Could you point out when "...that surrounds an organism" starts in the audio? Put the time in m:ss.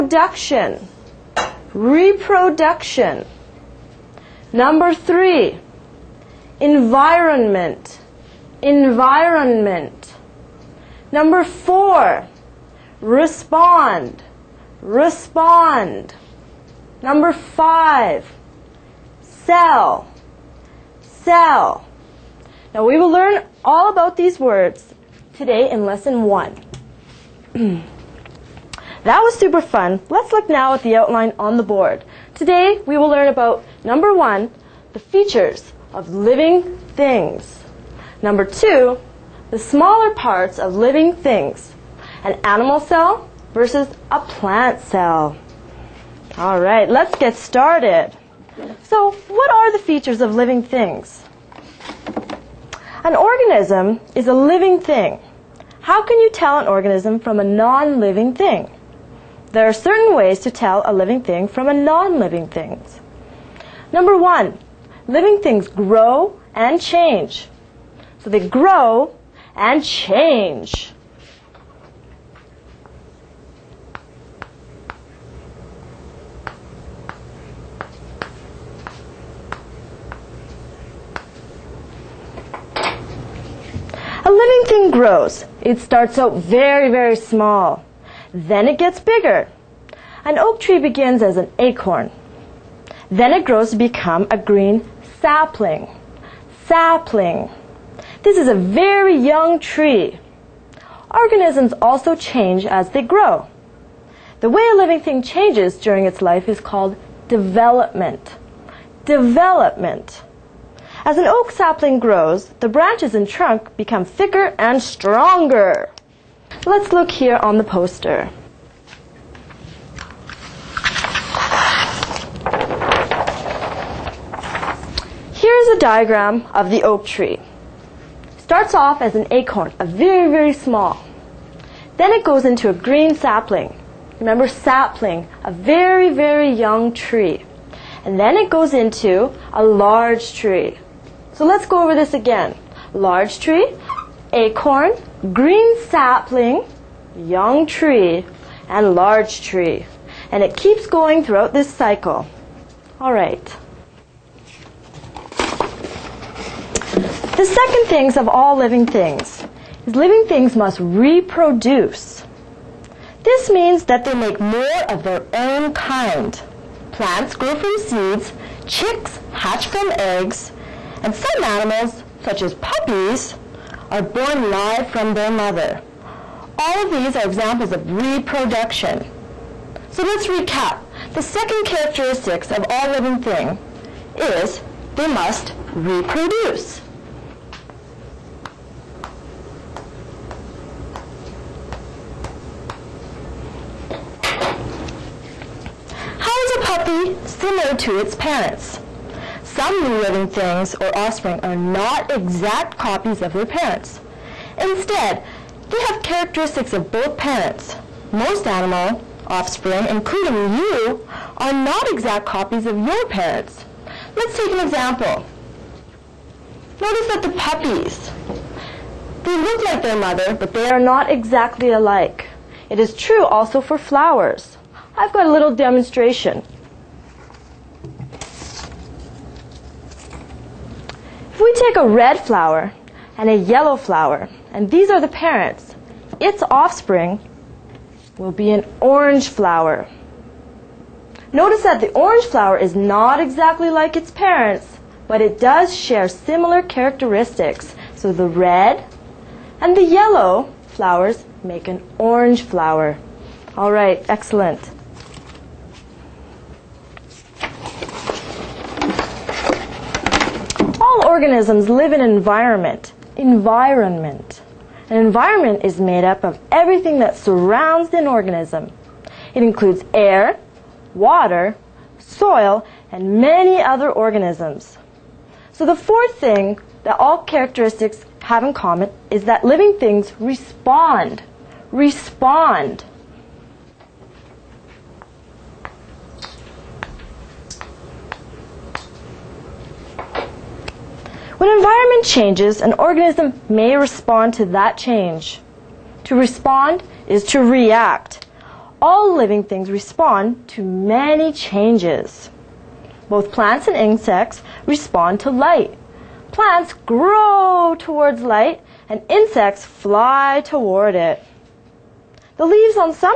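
4:26.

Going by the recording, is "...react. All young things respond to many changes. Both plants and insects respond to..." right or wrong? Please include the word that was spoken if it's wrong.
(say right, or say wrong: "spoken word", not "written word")
wrong: "living", not "young".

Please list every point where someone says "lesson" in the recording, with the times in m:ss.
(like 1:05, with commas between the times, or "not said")
0:25.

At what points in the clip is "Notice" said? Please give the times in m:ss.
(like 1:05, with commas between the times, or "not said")
3:36, 4:01.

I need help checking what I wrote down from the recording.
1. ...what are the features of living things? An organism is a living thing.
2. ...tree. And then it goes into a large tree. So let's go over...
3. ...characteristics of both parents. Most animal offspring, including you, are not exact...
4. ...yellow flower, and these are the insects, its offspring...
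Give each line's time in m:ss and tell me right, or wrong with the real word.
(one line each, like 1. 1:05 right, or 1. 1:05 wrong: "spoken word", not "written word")
1. 0:49 right
2. 2:16 right
3. 3:26 right
4. 3:53 wrong: "parents", not "insects".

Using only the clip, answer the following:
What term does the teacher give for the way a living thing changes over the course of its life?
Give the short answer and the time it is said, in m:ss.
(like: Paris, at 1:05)
development, at 1:46.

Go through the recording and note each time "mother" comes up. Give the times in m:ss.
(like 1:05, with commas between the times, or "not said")
2:55, 3:39.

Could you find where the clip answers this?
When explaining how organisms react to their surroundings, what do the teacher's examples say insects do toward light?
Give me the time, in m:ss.
5:09.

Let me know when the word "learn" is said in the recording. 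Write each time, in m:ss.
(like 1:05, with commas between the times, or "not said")
0:23, 0:33.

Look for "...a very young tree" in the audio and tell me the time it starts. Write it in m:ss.
1:38.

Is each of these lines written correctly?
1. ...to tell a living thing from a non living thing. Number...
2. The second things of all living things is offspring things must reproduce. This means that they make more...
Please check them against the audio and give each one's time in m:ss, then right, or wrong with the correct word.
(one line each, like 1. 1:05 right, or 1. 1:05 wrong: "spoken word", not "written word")
1. 1:00 right
2. 2:37 wrong: "living", not "offspring".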